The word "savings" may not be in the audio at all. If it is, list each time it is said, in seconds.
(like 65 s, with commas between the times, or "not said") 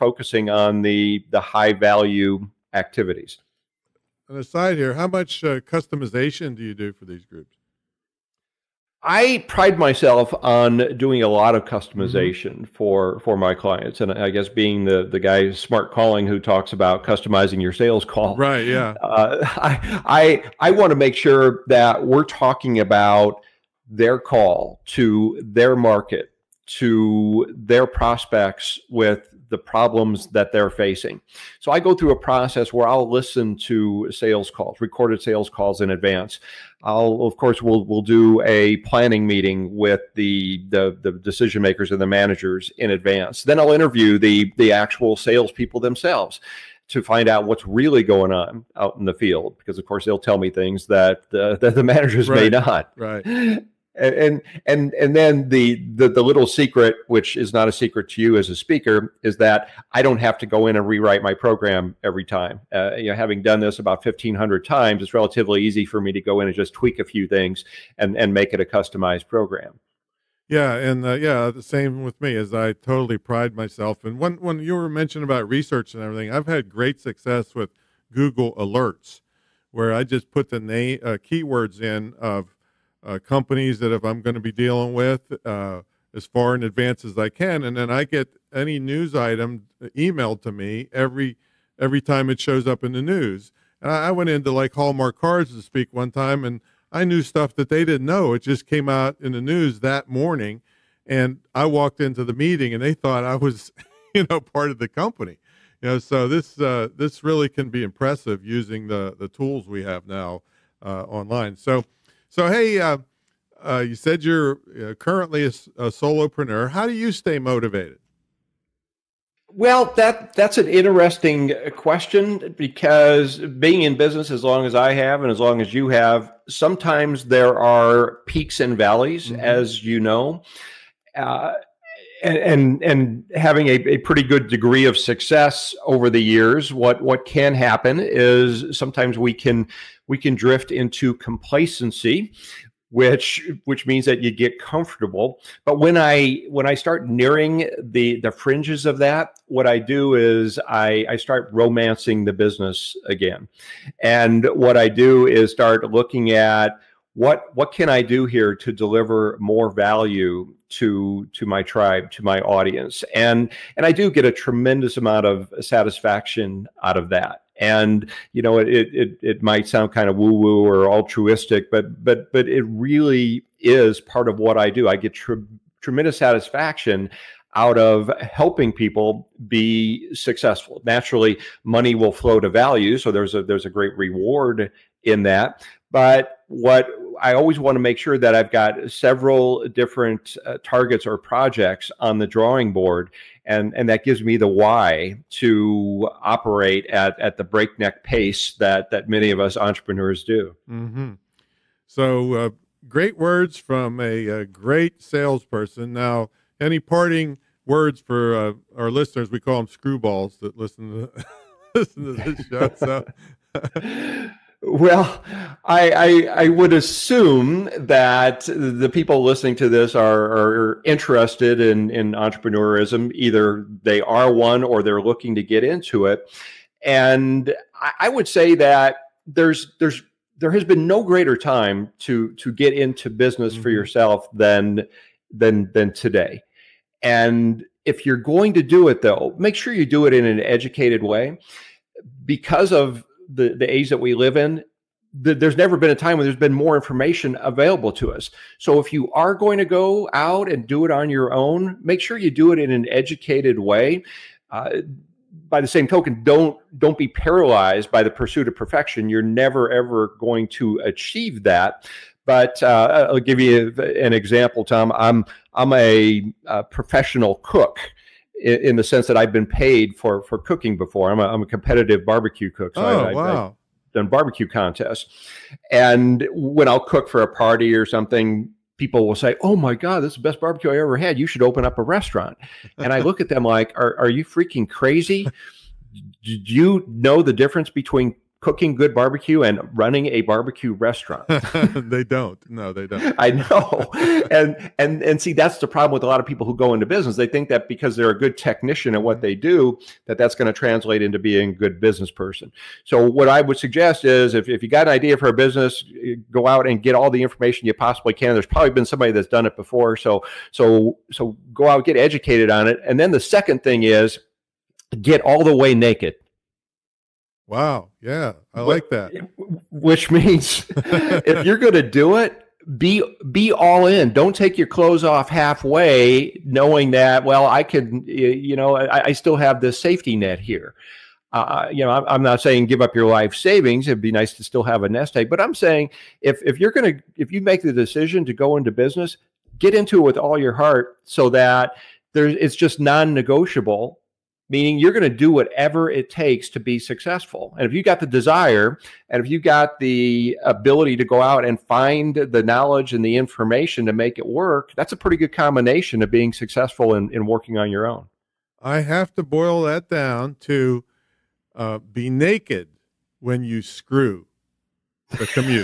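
333 s.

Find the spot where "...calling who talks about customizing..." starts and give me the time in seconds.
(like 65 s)
15 s.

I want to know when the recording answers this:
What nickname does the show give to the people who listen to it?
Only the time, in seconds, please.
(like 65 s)
209 s.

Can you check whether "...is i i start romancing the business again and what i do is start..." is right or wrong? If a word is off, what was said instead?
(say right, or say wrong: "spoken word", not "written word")
right.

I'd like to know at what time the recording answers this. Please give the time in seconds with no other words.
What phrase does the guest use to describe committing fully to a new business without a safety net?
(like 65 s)
315 s.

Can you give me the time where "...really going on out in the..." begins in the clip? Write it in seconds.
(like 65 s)
47 s.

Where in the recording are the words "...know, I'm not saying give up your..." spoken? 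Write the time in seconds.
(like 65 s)
331 s.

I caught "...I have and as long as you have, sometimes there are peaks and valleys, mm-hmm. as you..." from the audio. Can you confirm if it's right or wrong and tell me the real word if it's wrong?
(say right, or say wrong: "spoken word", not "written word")
right.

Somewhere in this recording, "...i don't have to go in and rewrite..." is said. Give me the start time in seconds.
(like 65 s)
59 s.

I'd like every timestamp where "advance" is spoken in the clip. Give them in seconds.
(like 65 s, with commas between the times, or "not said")
35 s, 42 s, 86 s.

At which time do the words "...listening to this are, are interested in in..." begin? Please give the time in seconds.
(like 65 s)
219 s.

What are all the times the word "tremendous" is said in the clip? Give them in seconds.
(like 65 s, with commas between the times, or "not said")
164 s, 175 s.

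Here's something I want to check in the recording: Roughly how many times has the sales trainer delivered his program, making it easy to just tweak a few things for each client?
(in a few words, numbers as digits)
1500.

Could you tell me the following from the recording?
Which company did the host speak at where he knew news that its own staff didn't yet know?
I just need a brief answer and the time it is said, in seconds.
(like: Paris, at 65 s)
Hallmark Cards, at 94 s.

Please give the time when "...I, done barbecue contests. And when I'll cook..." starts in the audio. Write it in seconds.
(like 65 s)
273 s.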